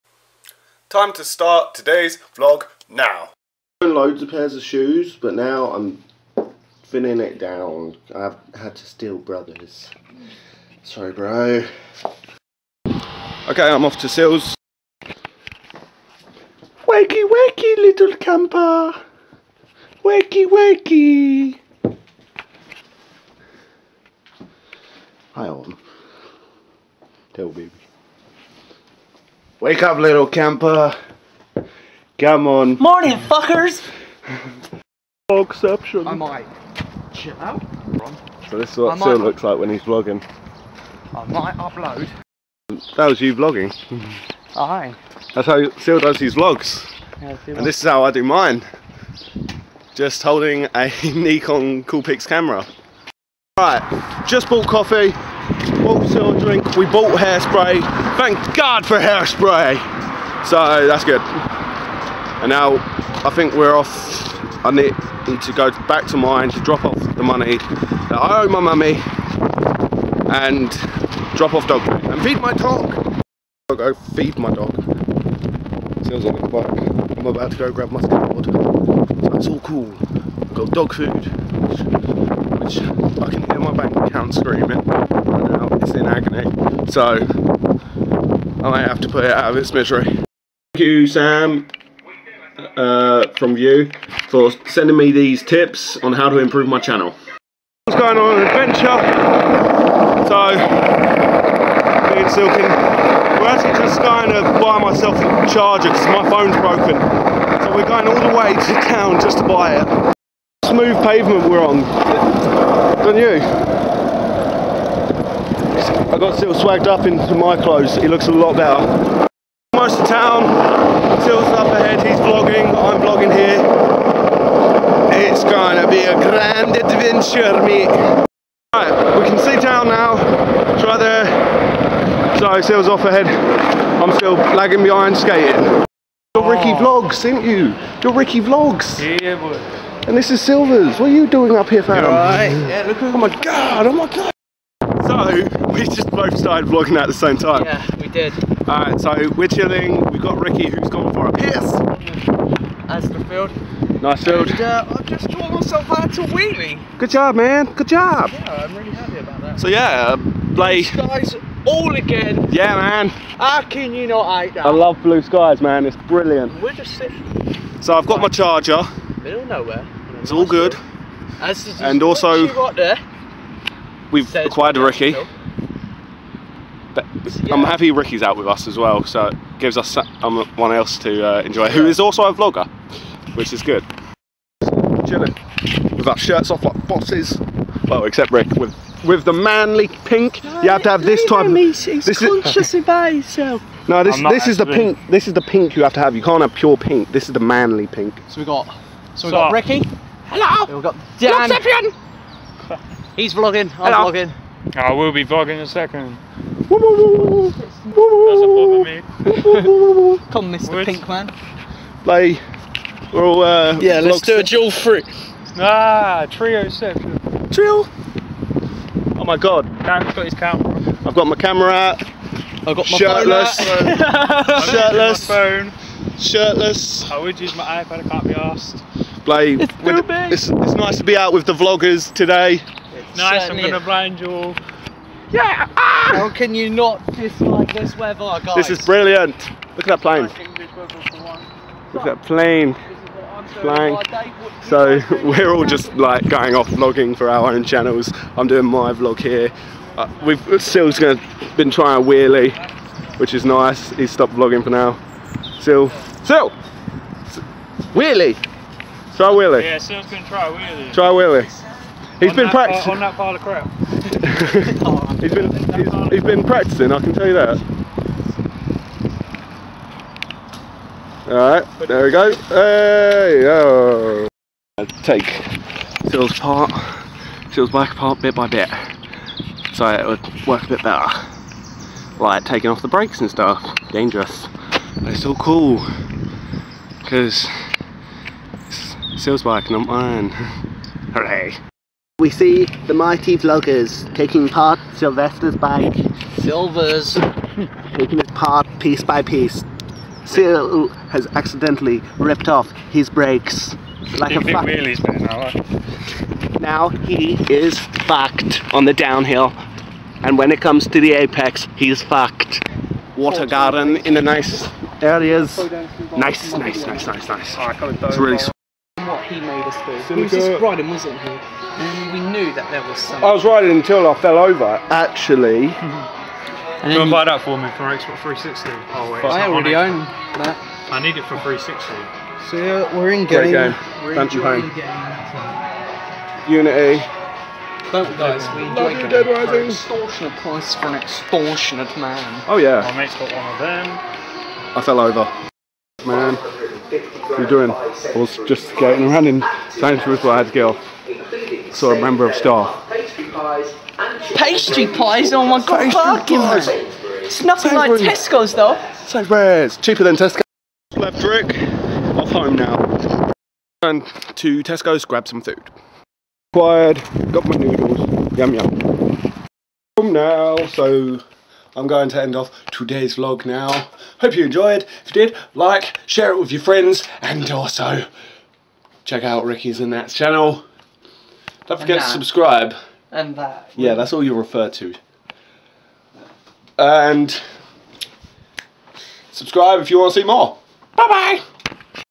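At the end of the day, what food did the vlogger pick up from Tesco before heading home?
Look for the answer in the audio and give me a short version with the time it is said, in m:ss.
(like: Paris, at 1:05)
Noodles, at 6:07.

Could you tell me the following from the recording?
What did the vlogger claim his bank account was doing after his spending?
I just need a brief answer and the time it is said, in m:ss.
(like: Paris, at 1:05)
Screaming, at 1:24.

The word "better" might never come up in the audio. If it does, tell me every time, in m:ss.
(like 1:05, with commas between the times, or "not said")
1:58, 4:40.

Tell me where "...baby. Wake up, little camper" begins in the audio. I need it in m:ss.
0:27.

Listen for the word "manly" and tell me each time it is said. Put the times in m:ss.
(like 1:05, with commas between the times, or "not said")
3:09, 3:17.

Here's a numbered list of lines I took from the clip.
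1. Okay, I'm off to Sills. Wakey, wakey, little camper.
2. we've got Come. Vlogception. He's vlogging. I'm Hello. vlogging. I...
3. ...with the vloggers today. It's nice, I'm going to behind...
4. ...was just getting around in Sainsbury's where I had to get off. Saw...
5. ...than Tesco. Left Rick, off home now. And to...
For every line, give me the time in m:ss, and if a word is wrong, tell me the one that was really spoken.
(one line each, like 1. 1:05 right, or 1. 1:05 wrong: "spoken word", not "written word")
1. 0:12 right
2. 3:20 wrong: "Dan", not "Come"
3. 3:51 wrong: "blind", not "behind"
4. 5:48 right
5. 6:00 right.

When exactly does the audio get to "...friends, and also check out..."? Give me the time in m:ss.
6:16.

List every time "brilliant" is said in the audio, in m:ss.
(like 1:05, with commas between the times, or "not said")
2:46, 3:58.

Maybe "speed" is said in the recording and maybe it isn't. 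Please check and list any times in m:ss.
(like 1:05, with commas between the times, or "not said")
not said.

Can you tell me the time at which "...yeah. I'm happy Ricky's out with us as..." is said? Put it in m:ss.
2:57.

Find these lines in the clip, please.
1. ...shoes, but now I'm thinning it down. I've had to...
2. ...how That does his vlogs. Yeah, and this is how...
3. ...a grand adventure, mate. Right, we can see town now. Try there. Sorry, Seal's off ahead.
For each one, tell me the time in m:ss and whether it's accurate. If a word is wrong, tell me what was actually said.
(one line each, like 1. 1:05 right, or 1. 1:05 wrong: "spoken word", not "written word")
1. 0:04 right
2. 0:45 wrong: "Phil", not "That"
3. 2:06 right.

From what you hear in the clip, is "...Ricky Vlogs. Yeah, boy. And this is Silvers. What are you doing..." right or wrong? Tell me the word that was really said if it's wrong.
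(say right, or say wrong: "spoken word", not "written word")
right.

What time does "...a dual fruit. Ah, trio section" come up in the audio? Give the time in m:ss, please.
3:34.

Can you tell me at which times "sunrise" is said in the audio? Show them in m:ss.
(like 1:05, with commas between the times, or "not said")
not said.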